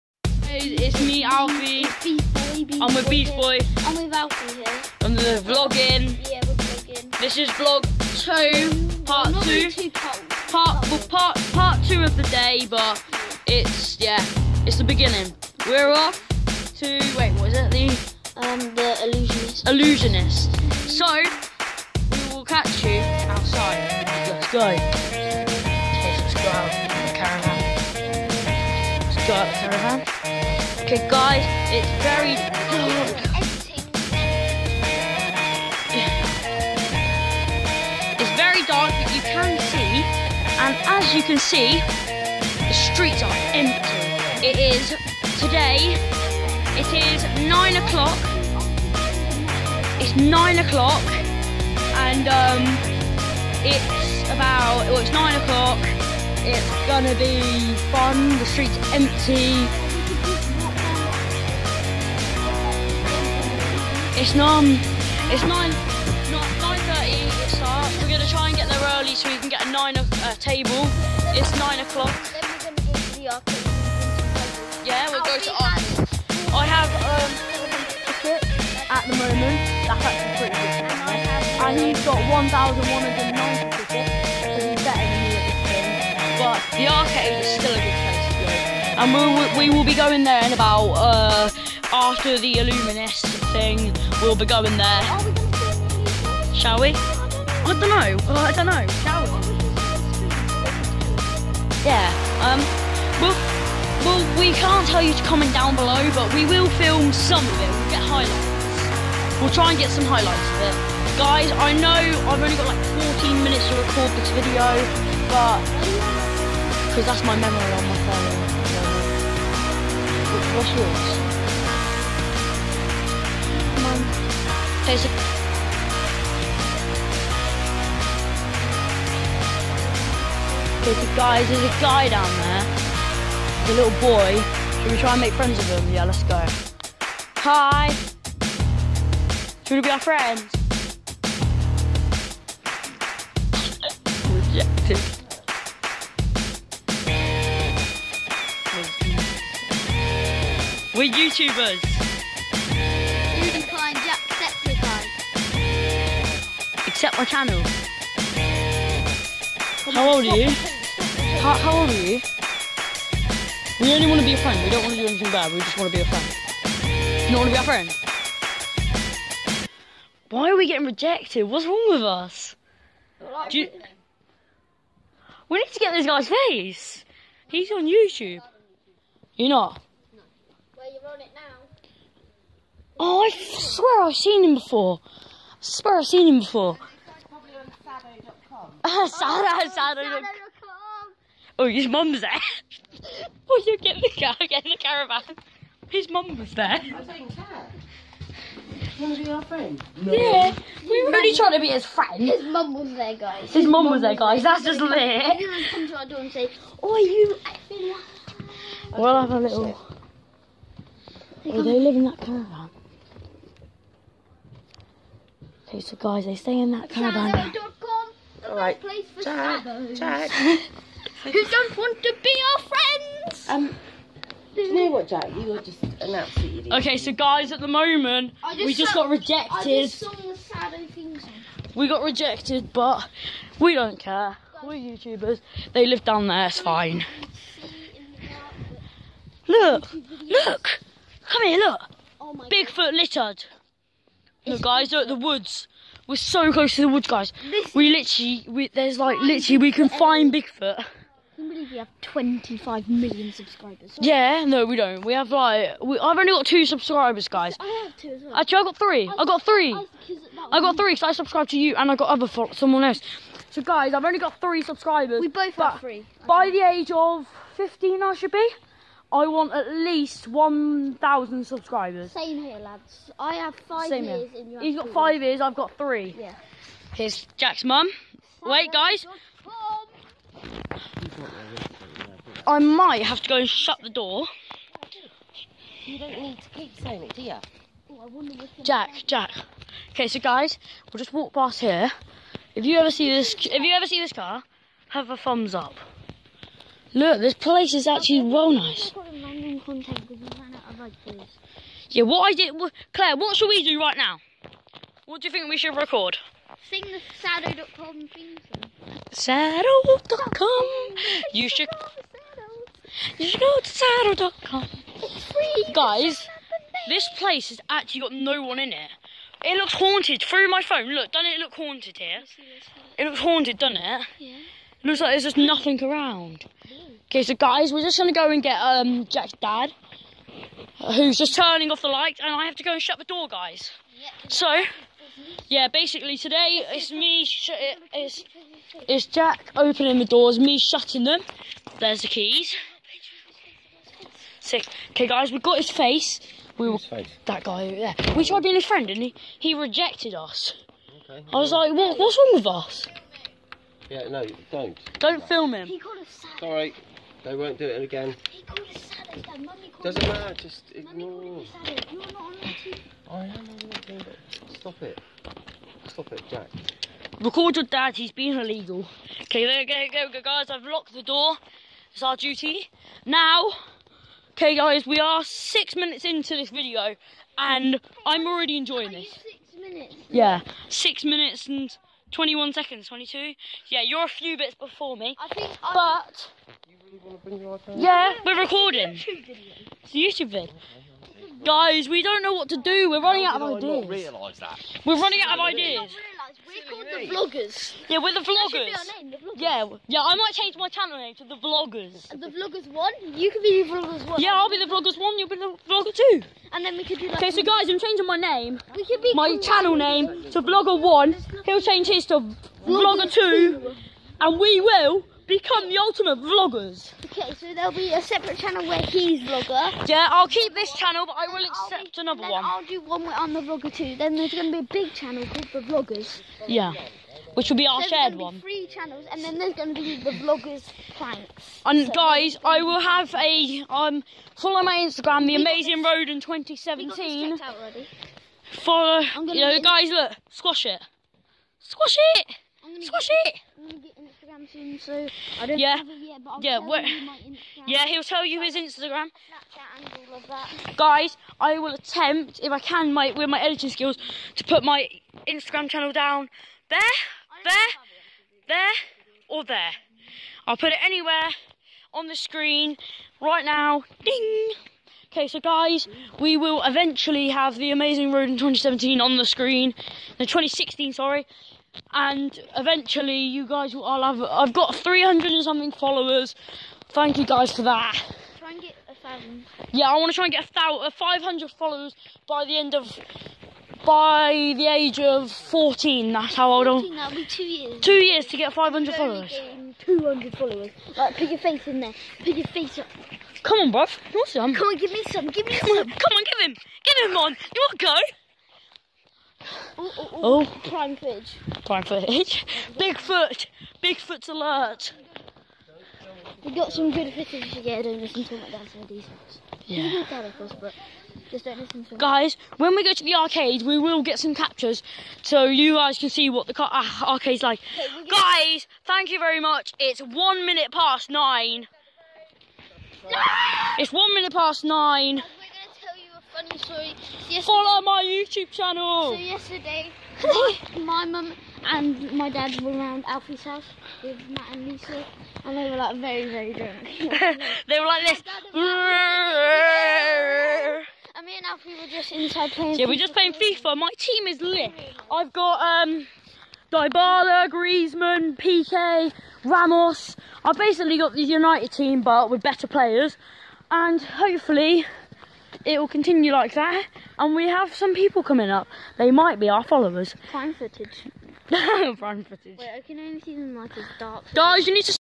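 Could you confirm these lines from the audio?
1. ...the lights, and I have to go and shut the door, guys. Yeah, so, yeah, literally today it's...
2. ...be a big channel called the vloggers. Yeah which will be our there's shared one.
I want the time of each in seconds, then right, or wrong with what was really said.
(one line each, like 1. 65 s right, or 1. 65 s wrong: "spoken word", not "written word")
1. 331 s wrong: "basically", not "literally"
2. 424 s right.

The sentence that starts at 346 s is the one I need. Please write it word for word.
We were, That guy over there.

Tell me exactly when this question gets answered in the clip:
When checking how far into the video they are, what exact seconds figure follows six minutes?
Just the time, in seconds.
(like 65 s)
382 s.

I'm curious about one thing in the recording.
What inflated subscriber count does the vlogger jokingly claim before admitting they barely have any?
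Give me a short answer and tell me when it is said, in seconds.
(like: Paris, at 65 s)
25 million, at 252 s.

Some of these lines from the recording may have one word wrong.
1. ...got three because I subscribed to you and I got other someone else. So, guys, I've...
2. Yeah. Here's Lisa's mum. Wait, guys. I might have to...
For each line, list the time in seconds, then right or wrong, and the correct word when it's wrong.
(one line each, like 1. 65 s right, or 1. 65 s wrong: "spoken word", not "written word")
1. 260 s right
2. 276 s wrong: "Jack", not "Lisa".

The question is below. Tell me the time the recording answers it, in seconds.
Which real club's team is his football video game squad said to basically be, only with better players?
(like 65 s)
551 s.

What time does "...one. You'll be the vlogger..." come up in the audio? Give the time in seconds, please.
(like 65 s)
404 s.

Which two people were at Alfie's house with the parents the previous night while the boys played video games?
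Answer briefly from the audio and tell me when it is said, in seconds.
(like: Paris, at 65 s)
Matt and Lisa, at 534 s.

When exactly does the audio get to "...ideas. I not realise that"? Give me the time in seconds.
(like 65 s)
393 s.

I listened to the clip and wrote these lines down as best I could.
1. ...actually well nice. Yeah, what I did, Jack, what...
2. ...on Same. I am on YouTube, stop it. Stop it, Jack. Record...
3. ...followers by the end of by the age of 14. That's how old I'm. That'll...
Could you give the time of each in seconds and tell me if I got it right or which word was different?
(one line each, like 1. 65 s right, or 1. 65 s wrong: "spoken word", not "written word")
1. 297 s wrong: "Claire", not "Jack"
2. 362 s wrong: "YouTube", not "Same"
3. 481 s right.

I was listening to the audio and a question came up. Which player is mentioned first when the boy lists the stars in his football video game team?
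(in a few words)
Dybala.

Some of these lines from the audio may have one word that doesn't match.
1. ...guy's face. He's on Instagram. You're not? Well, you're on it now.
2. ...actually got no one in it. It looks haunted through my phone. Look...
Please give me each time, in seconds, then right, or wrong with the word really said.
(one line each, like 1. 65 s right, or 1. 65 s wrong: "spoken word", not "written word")
1. 176 s wrong: "YouTube", not "Instagram"
2. 317 s right.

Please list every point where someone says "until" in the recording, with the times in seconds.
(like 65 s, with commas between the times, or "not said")
508 s.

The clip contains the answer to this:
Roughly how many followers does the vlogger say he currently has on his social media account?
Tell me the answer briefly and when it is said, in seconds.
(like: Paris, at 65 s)
300 and something, at 474 s.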